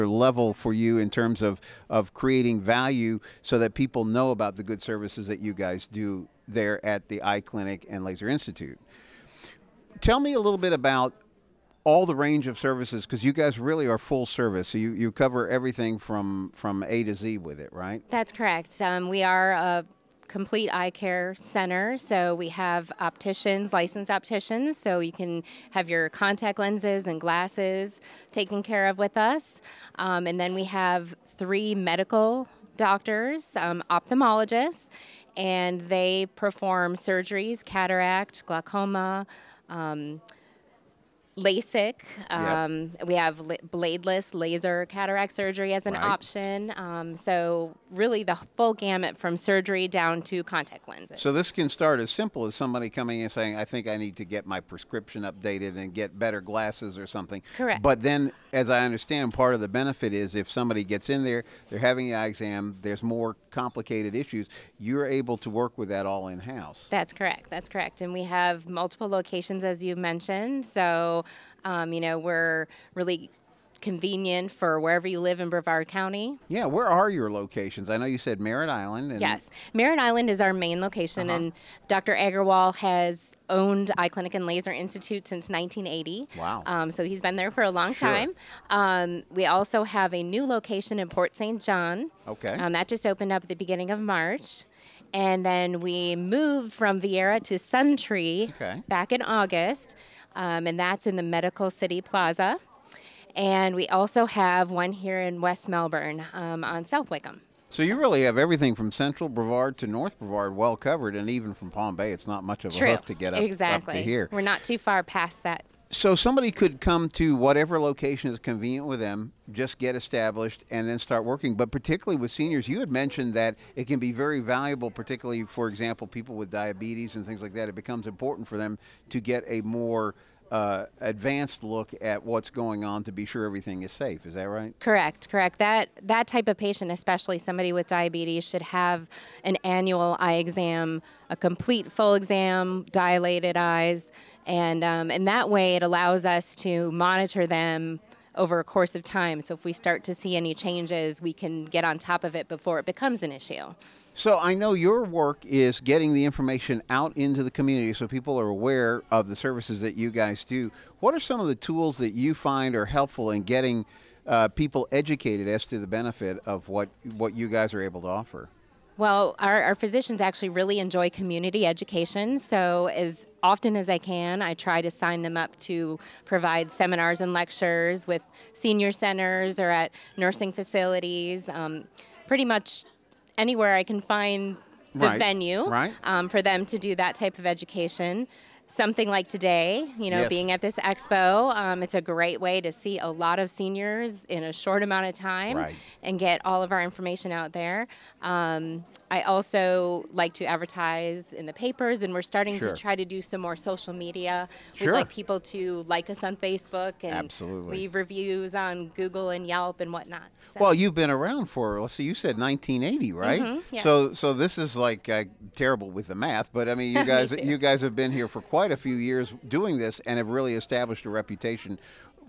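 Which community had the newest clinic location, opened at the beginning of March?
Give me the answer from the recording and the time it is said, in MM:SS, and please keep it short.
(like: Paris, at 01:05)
Port St. John, at 01:31.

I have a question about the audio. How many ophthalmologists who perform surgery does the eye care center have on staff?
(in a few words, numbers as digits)
3.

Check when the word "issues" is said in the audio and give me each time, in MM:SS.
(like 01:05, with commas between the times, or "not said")
01:04, 02:33.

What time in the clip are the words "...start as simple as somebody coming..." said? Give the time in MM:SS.
00:51.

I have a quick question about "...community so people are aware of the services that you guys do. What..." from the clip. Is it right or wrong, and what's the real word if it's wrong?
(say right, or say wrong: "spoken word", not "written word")
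right.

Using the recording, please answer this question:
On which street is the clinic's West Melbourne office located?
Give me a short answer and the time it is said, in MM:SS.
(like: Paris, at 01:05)
South Wickham, at 01:46.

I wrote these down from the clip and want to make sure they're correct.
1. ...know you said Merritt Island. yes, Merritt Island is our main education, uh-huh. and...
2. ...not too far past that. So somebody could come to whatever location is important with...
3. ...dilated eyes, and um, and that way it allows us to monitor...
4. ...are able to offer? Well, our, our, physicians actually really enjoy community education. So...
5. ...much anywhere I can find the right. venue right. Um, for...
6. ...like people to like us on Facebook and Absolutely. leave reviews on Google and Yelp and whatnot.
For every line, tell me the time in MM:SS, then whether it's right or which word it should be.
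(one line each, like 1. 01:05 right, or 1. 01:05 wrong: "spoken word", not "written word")
1. 01:17 wrong: "location", not "education"
2. 01:54 wrong: "convenient", not "important"
3. 02:22 right
4. 02:47 right
5. 03:02 right
6. 03:24 right.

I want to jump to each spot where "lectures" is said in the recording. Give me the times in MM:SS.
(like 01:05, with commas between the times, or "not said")
02:57.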